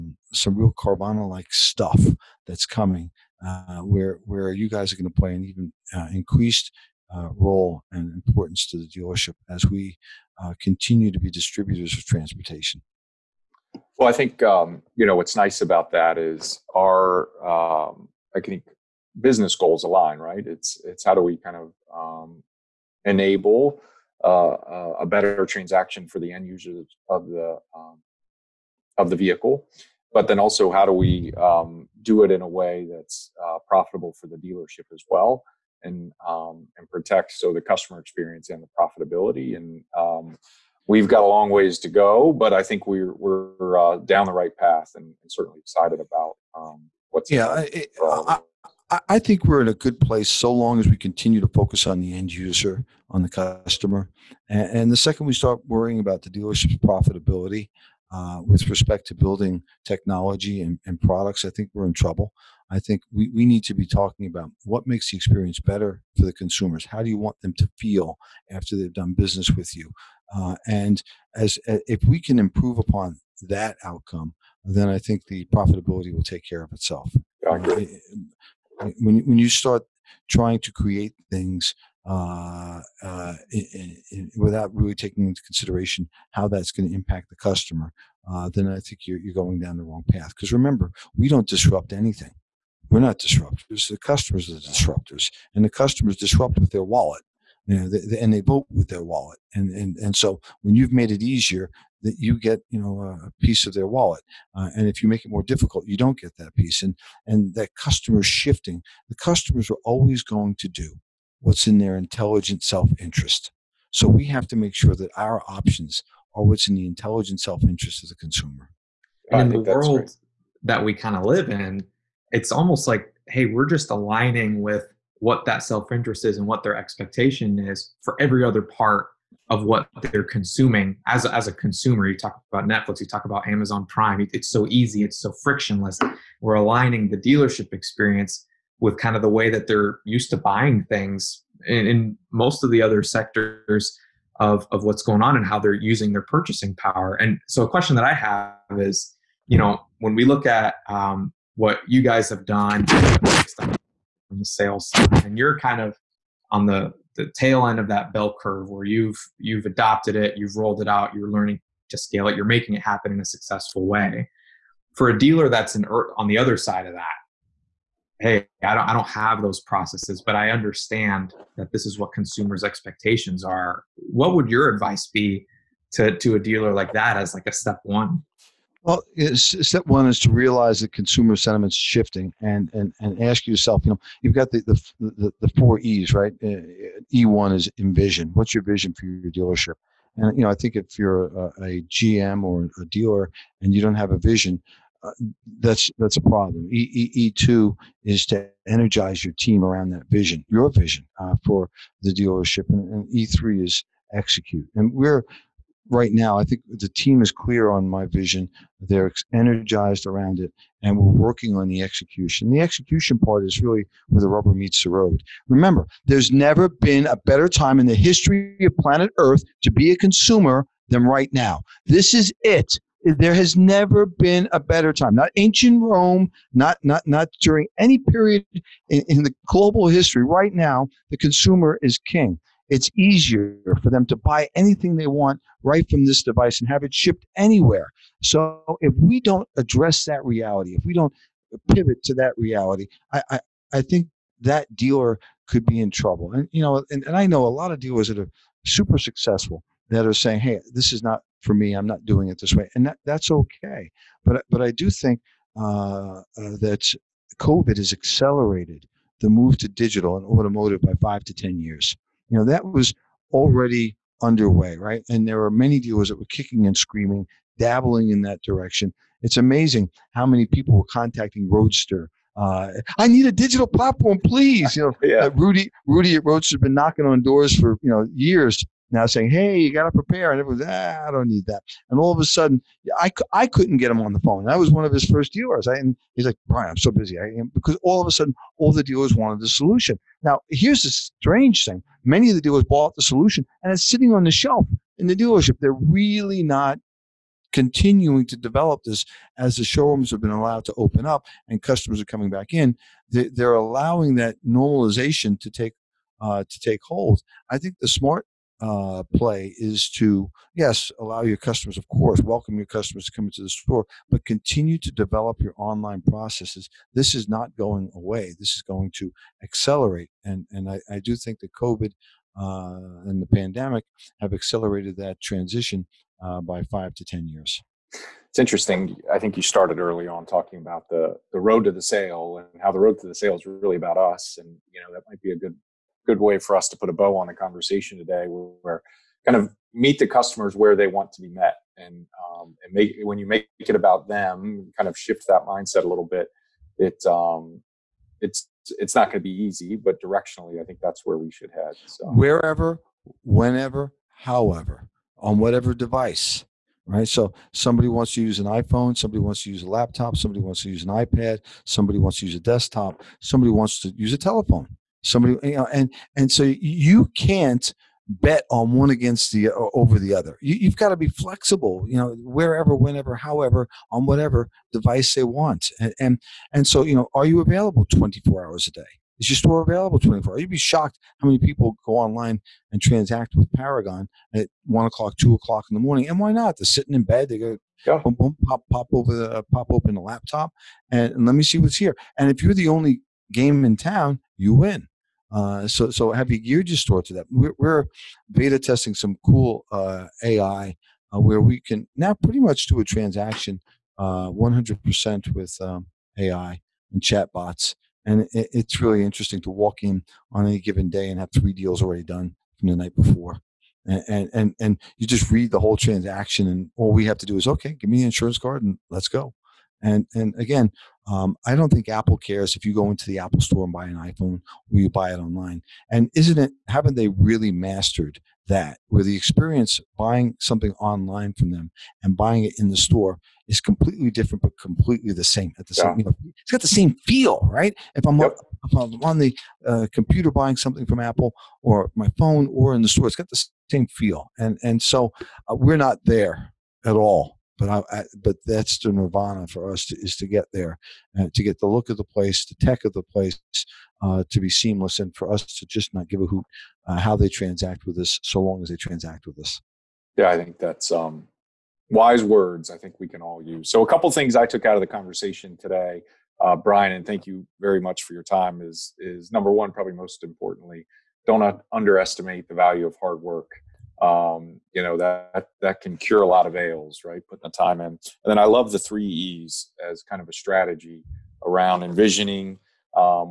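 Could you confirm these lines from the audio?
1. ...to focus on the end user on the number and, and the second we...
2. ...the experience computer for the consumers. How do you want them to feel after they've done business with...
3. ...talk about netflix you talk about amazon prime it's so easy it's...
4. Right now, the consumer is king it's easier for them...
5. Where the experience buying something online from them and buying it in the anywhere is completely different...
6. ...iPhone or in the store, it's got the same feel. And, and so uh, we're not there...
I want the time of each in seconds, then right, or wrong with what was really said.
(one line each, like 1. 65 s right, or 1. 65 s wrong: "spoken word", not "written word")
1. 51 s wrong: "customer", not "number"
2. 65 s wrong: "better", not "computer"
3. 132 s right
4. 230 s right
5. 428 s wrong: "store", not "anywhere"
6. 442 s wrong: "phone", not "iPhone".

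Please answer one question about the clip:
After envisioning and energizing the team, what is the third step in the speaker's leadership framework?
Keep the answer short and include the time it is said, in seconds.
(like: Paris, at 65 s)
Execute, at 204 s.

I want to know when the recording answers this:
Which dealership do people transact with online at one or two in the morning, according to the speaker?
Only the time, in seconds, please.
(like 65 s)
383 s.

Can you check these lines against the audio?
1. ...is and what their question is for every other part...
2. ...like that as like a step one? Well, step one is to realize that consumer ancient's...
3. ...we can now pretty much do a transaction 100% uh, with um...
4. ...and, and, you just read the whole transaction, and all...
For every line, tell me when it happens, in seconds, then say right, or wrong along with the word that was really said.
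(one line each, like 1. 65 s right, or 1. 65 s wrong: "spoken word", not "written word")
1. 126 s wrong: "expectation", not "question"
2. 176 s wrong: "sentiment", not "ancient"
3. 401 s right
4. 414 s right.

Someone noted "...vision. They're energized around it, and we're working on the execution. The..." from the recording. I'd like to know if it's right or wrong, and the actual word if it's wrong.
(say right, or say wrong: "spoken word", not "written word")
right.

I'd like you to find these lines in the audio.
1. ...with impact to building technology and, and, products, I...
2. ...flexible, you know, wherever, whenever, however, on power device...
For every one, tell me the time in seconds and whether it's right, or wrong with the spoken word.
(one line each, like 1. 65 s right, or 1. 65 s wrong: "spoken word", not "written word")
1. 58 s wrong: "respect", not "impact"
2. 371 s wrong: "whatever", not "power".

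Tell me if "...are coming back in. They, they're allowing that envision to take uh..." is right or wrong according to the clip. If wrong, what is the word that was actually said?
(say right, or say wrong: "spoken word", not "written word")
wrong: "normalization", not "envision".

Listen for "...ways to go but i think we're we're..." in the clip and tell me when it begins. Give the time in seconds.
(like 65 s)
41 s.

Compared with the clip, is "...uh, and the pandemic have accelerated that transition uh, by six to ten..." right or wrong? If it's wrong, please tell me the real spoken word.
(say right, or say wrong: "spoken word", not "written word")
wrong: "five", not "six".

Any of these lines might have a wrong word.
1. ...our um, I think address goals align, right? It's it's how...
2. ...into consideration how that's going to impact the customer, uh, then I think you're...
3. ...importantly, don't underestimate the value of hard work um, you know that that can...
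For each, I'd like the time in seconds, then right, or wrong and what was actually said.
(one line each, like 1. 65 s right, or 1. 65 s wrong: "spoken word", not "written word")
1. 16 s wrong: "business", not "address"
2. 85 s right
3. 470 s right.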